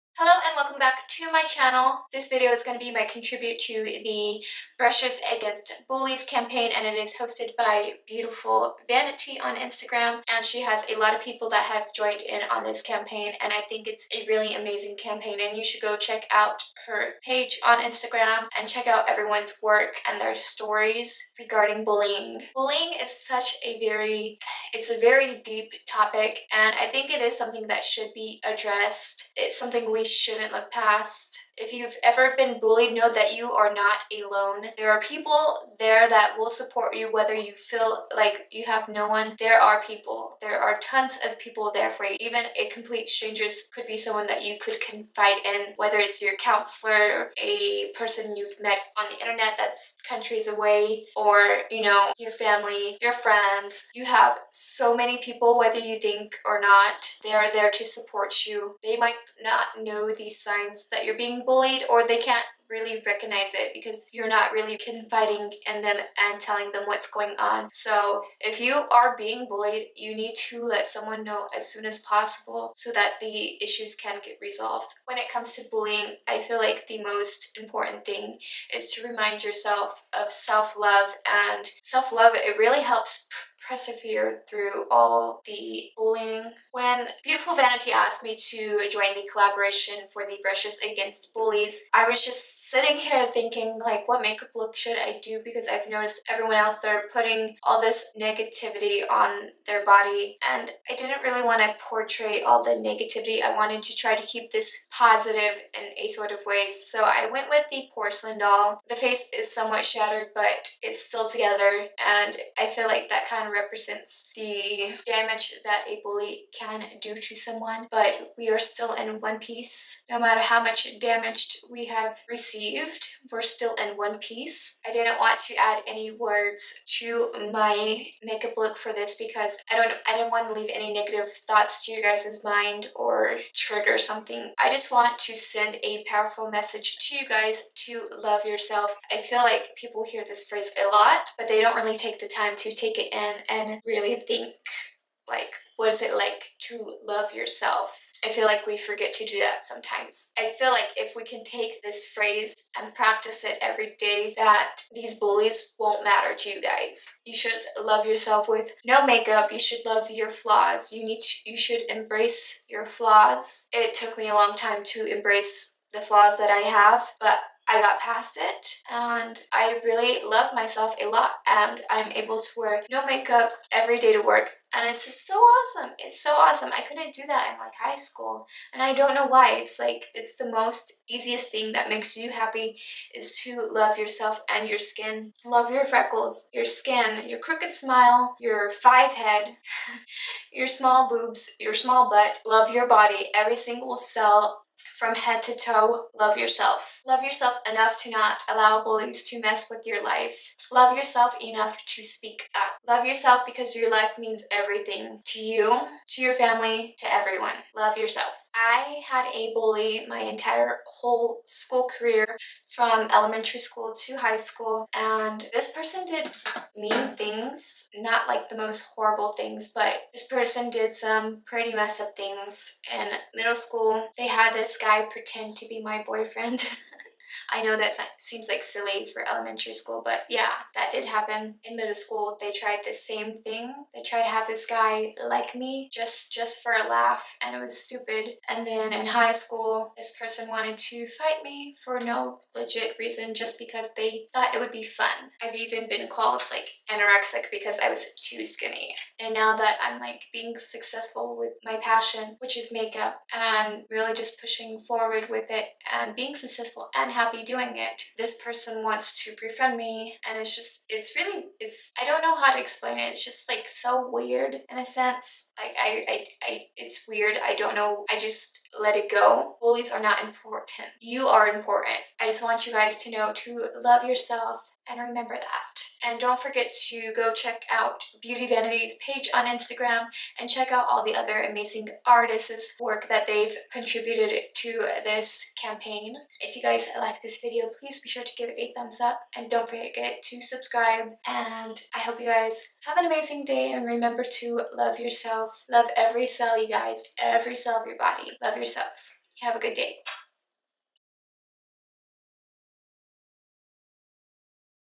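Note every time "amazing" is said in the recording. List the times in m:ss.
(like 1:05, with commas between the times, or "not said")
0:14, 4:41, 4:53.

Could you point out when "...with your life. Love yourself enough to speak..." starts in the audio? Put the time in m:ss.
3:19.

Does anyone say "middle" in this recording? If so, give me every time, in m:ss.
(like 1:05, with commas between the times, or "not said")
3:43, 3:51.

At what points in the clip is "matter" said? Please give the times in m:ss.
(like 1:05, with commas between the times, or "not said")
2:00, 2:36.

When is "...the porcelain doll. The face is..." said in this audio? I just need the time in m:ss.
1:47.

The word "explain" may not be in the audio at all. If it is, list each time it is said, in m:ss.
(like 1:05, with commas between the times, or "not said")
4:22.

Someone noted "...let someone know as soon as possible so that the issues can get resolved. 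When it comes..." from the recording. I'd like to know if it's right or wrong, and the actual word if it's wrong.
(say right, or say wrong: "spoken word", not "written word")
right.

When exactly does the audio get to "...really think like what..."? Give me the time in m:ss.
2:23.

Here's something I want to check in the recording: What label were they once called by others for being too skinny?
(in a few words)
anorexic.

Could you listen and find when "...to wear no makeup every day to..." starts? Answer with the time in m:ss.
2:52.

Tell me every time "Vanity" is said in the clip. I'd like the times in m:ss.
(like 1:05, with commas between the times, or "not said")
0:08, 1:27, 4:38.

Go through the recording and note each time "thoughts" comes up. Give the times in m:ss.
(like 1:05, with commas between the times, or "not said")
2:11, 4:04.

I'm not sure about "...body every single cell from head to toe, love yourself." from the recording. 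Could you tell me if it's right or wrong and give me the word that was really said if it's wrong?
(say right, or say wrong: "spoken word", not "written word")
right.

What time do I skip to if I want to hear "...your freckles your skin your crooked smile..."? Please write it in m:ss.
3:05.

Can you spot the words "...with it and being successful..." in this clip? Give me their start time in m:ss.
4:15.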